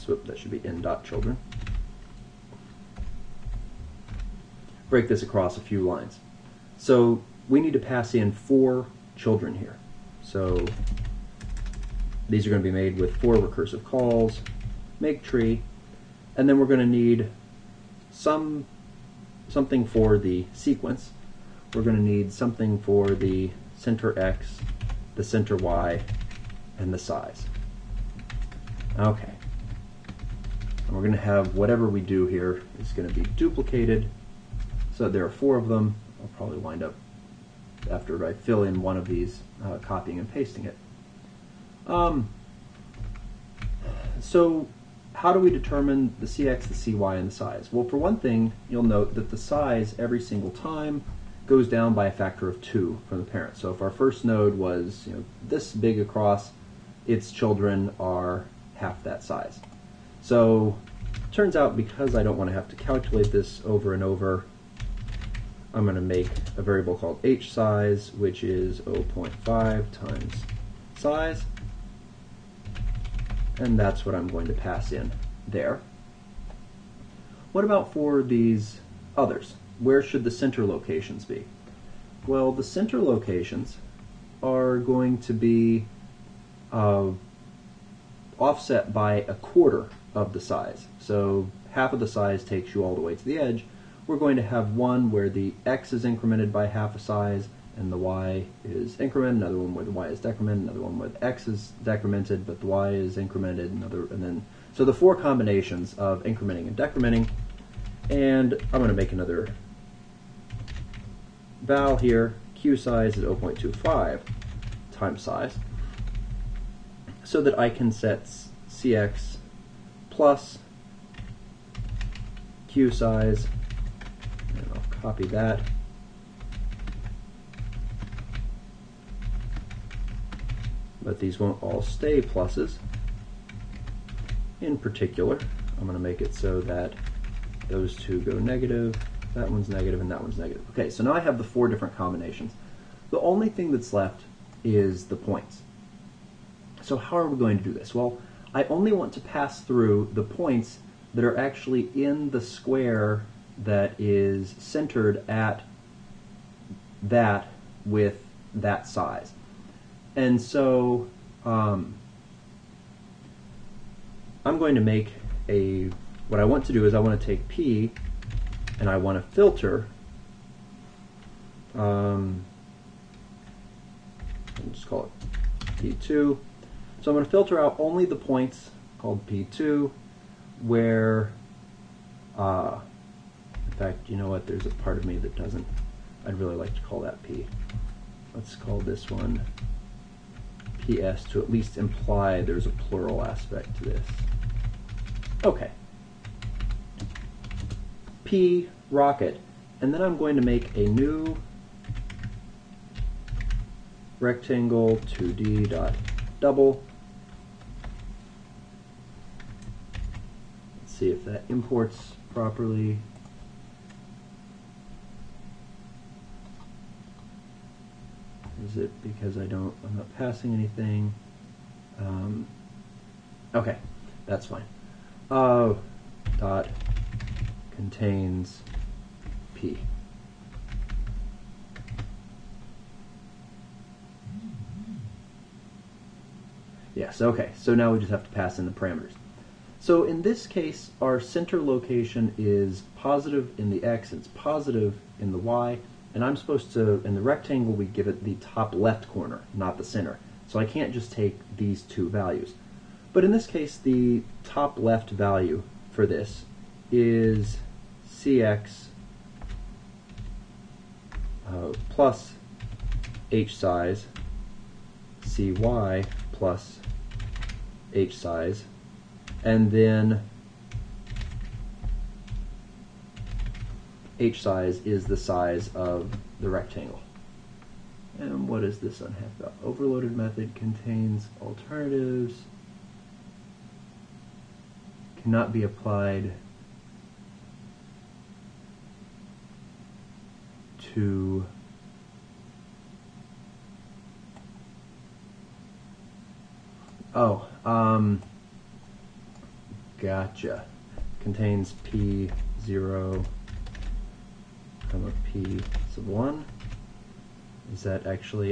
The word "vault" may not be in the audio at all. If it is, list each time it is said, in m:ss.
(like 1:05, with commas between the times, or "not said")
not said.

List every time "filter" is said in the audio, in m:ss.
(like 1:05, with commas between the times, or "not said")
2:49, 2:57.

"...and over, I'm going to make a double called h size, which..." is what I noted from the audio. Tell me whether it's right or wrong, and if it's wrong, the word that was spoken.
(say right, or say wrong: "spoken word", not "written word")
wrong: "variable", not "double".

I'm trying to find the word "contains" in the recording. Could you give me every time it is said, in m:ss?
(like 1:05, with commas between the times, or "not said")
3:47, 4:40, 5:01.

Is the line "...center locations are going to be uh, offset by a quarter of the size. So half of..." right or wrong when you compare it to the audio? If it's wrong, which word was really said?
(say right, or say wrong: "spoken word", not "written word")
right.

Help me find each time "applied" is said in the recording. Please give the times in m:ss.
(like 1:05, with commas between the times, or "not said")
4:45.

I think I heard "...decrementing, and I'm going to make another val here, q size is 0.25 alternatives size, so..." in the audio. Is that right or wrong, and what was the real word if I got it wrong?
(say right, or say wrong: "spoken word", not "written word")
wrong: "times", not "alternatives".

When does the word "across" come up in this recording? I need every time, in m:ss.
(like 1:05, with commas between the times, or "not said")
0:05, 0:55.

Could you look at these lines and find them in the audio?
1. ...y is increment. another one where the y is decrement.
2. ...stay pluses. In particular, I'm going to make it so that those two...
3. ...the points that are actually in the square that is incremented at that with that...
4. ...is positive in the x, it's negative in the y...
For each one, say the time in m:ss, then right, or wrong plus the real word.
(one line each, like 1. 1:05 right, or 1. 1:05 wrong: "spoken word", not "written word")
1. 1:37 right
2. 2:11 right
3. 2:30 wrong: "centered", not "incremented"
4. 4:02 wrong: "positive", not "negative".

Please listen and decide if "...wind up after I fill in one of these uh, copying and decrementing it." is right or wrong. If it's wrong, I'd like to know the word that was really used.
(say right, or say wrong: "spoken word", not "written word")
wrong: "pasting", not "decrementing".